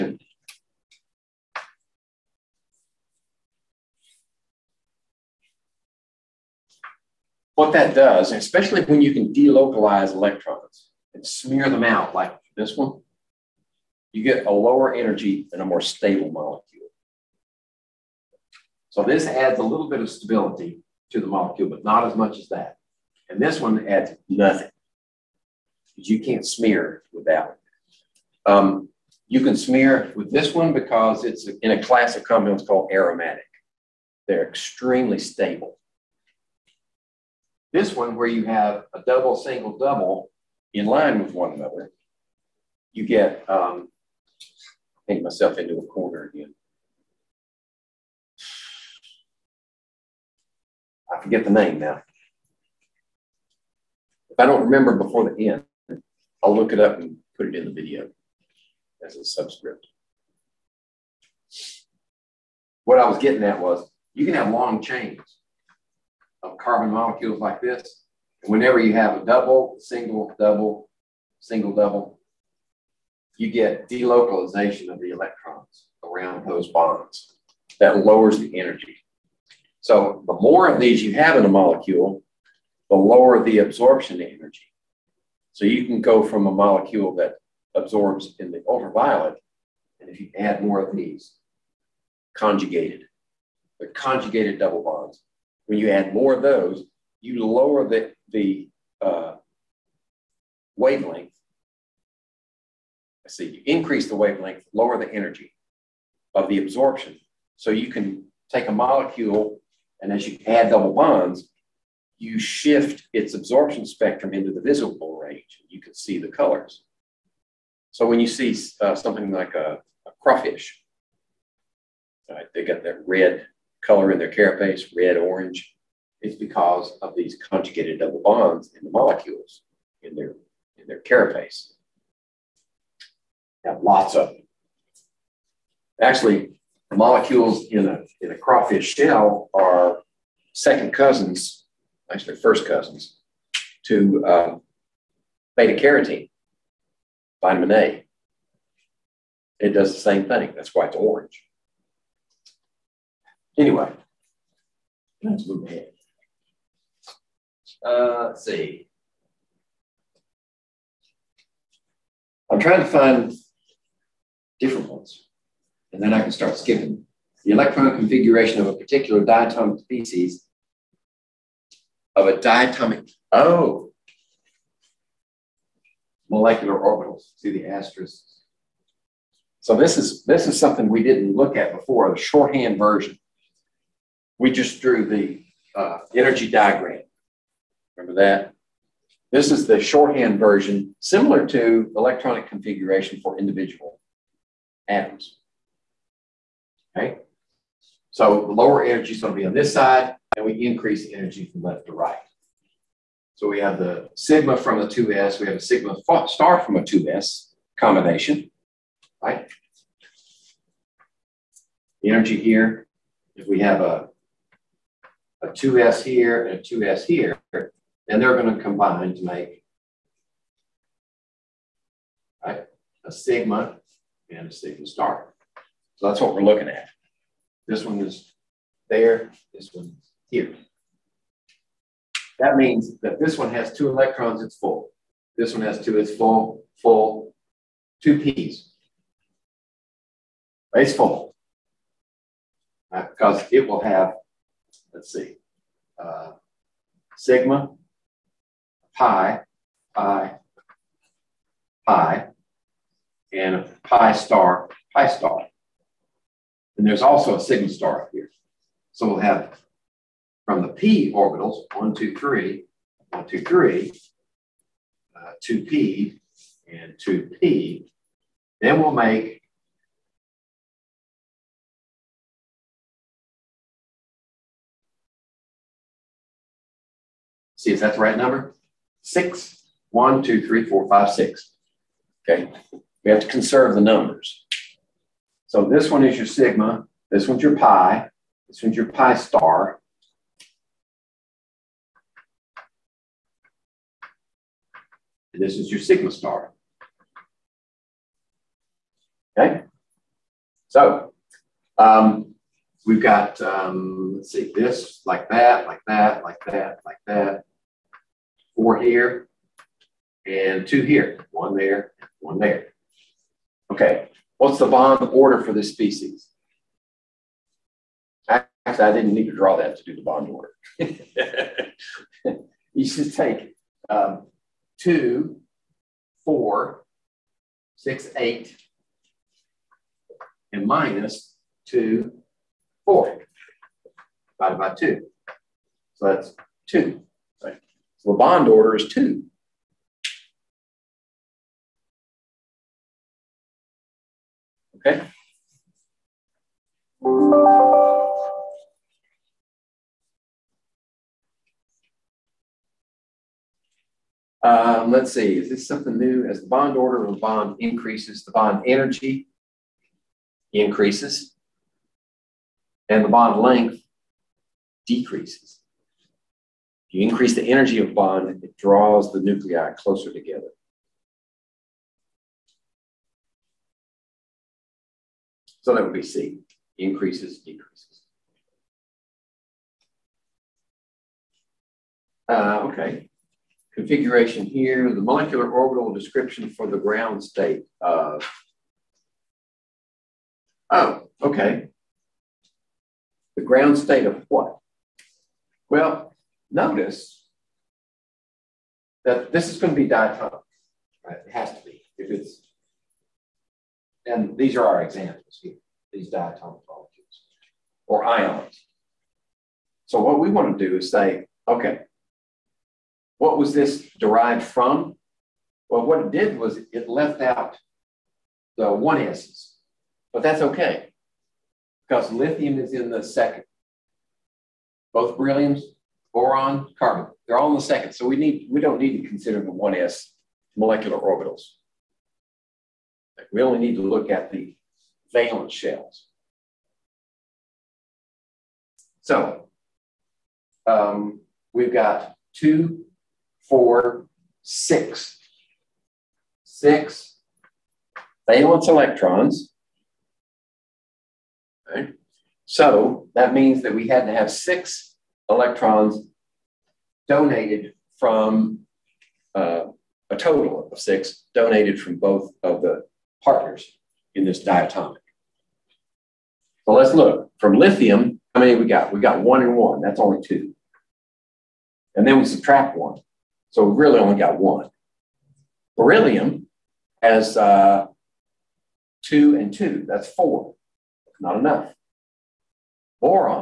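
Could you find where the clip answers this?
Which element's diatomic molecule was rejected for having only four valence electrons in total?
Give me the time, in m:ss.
7:55.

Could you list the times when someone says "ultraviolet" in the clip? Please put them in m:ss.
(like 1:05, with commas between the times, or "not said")
1:28.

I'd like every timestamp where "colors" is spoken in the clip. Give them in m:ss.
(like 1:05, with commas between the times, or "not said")
1:56, 2:03.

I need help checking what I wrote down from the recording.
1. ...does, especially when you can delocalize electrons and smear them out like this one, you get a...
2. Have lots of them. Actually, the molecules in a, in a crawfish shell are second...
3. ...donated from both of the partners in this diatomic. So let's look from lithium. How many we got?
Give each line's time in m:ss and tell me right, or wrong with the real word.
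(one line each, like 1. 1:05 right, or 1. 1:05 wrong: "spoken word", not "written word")
1. 0:07 right
2. 2:13 right
3. 7:41 right.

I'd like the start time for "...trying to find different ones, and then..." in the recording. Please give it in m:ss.
2:42.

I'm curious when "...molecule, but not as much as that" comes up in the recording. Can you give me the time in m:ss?
0:21.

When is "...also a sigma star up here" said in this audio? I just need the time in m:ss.
4:17.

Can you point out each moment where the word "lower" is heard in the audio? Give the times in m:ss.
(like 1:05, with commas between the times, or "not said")
0:14, 1:18, 1:22, 1:37, 1:44, 3:18.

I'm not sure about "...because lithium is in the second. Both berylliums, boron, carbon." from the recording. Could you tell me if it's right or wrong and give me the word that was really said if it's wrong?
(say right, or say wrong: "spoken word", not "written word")
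right.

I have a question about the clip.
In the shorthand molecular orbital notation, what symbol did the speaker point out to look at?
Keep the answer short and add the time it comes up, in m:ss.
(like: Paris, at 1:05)
asterisks, at 2:57.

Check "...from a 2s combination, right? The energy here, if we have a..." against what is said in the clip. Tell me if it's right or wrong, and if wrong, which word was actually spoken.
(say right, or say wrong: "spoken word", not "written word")
right.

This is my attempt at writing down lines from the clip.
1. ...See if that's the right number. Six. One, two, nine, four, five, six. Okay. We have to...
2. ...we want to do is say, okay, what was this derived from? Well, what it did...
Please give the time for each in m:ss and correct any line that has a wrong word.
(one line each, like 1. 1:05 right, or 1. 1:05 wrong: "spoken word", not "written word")
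1. 4:37 wrong: "three", not "nine"
2. 6:50 right.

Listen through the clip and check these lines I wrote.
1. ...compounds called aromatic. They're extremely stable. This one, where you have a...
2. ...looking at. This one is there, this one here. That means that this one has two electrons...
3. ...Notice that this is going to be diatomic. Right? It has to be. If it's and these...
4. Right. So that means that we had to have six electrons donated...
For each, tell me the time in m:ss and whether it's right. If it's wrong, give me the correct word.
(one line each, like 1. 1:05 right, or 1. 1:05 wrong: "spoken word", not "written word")
1. 0:32 right
2. 3:46 right
3. 6:36 right
4. 7:31 right.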